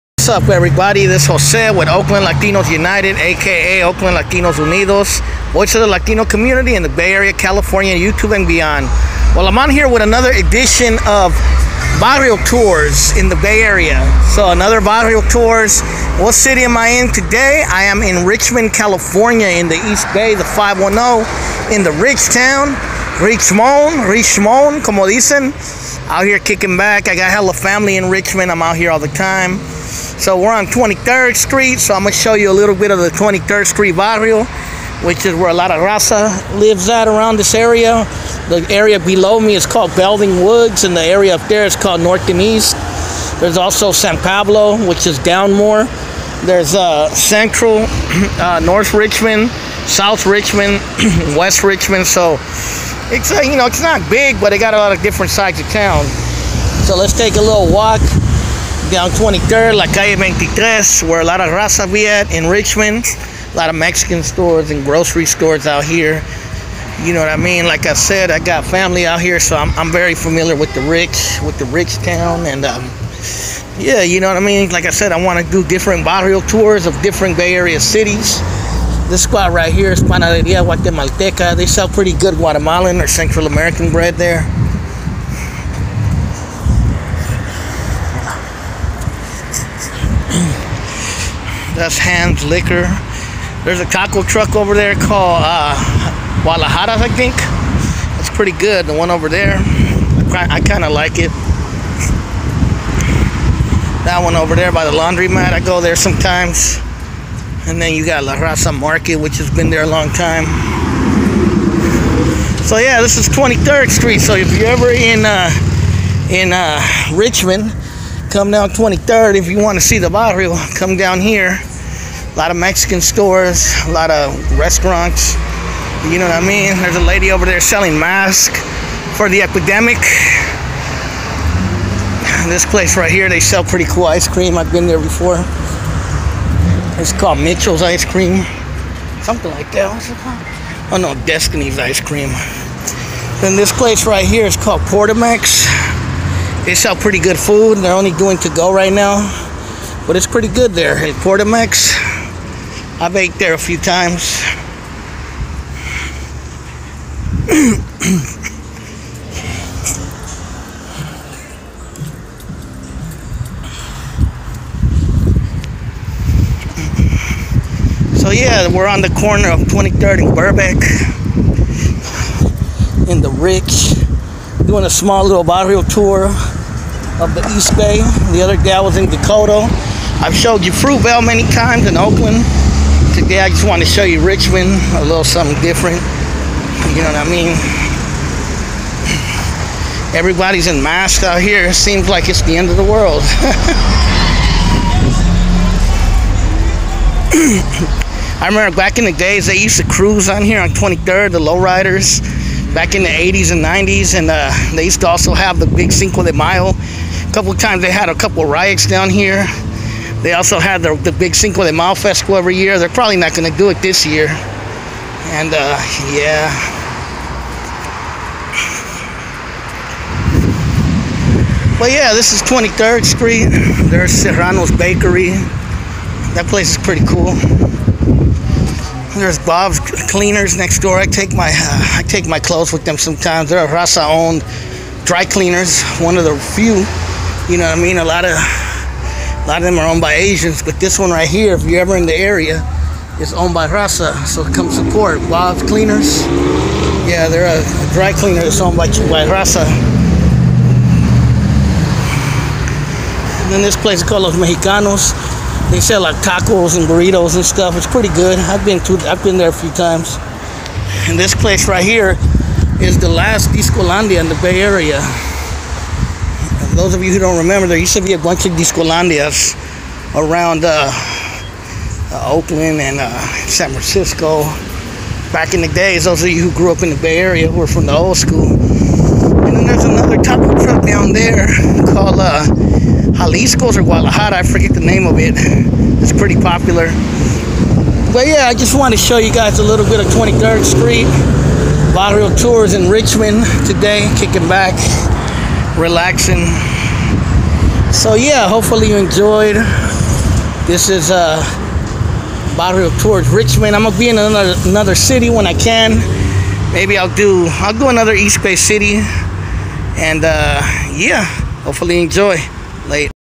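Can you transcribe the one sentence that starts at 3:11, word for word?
It seems like it's the end of the world.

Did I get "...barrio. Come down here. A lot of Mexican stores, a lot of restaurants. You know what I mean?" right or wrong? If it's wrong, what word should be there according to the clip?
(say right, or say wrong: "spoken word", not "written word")
right.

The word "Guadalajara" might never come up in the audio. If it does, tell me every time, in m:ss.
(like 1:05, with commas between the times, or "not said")
1:36, 4:43.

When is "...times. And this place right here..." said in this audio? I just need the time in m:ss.
4:19.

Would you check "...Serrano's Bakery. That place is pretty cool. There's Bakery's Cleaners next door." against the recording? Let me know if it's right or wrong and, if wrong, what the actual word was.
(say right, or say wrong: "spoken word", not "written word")
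wrong: "Bob", not "Bakery".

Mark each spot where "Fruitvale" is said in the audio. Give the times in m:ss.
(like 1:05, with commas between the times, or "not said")
3:00.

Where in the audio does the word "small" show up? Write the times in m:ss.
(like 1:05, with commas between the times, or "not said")
2:54.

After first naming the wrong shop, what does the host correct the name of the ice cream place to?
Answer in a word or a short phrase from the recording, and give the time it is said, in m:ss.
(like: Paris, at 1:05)
Destiny's Ice Cream, at 2:21.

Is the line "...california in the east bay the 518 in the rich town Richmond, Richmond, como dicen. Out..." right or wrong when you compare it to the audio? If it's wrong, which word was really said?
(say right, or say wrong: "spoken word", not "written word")
wrong: "510", not "518".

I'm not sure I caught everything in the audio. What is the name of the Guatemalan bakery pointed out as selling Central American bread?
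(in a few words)
Panaderia Guatemalteca.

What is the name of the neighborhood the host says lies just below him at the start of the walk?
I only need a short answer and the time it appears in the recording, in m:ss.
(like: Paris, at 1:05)
Belding Woods, at 0:39.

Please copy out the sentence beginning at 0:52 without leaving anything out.
So it's uh, you know it's not big, but it got a lot of different sides of town.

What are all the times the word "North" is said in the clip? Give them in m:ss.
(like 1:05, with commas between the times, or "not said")
0:42, 0:48.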